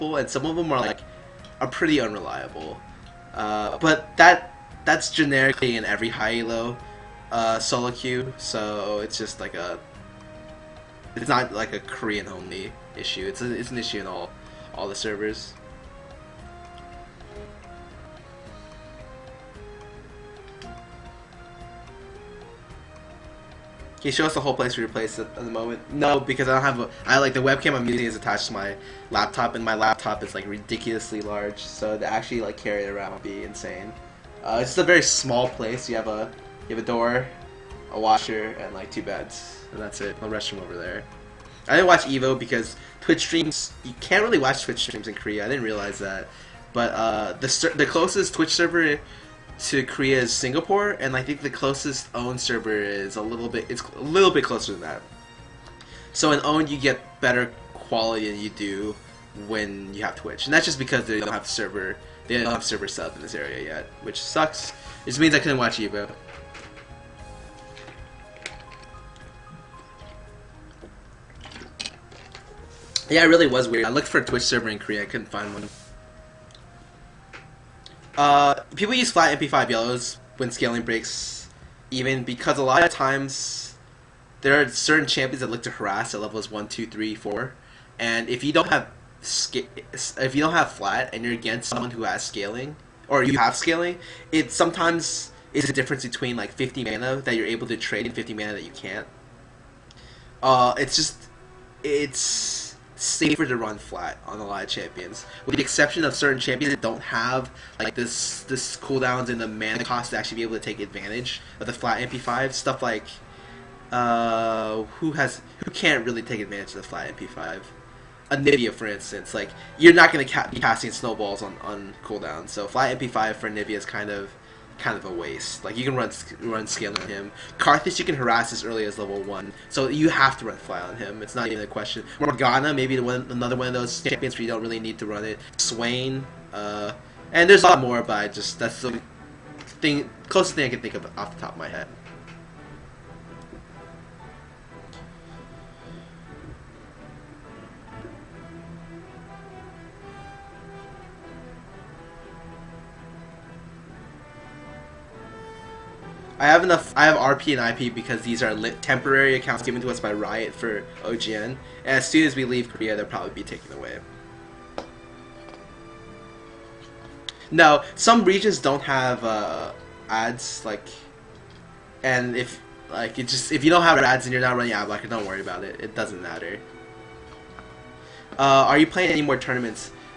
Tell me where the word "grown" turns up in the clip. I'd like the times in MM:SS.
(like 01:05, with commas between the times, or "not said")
not said.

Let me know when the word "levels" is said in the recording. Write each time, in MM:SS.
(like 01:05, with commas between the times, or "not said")
01:26, 02:08.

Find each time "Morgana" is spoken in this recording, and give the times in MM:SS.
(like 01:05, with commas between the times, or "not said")
02:12.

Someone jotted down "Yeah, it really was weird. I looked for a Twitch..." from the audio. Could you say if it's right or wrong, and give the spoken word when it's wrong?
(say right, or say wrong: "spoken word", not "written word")
right.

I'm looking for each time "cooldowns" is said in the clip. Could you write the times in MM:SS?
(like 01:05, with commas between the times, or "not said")
01:48, 02:02.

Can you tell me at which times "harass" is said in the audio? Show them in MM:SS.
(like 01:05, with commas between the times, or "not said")
01:25, 02:08.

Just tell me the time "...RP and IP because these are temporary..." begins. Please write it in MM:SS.
02:37.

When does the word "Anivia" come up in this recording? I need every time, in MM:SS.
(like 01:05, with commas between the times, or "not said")
01:58, 02:03.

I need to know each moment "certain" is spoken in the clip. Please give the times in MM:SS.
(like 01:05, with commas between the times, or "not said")
01:24, 01:46.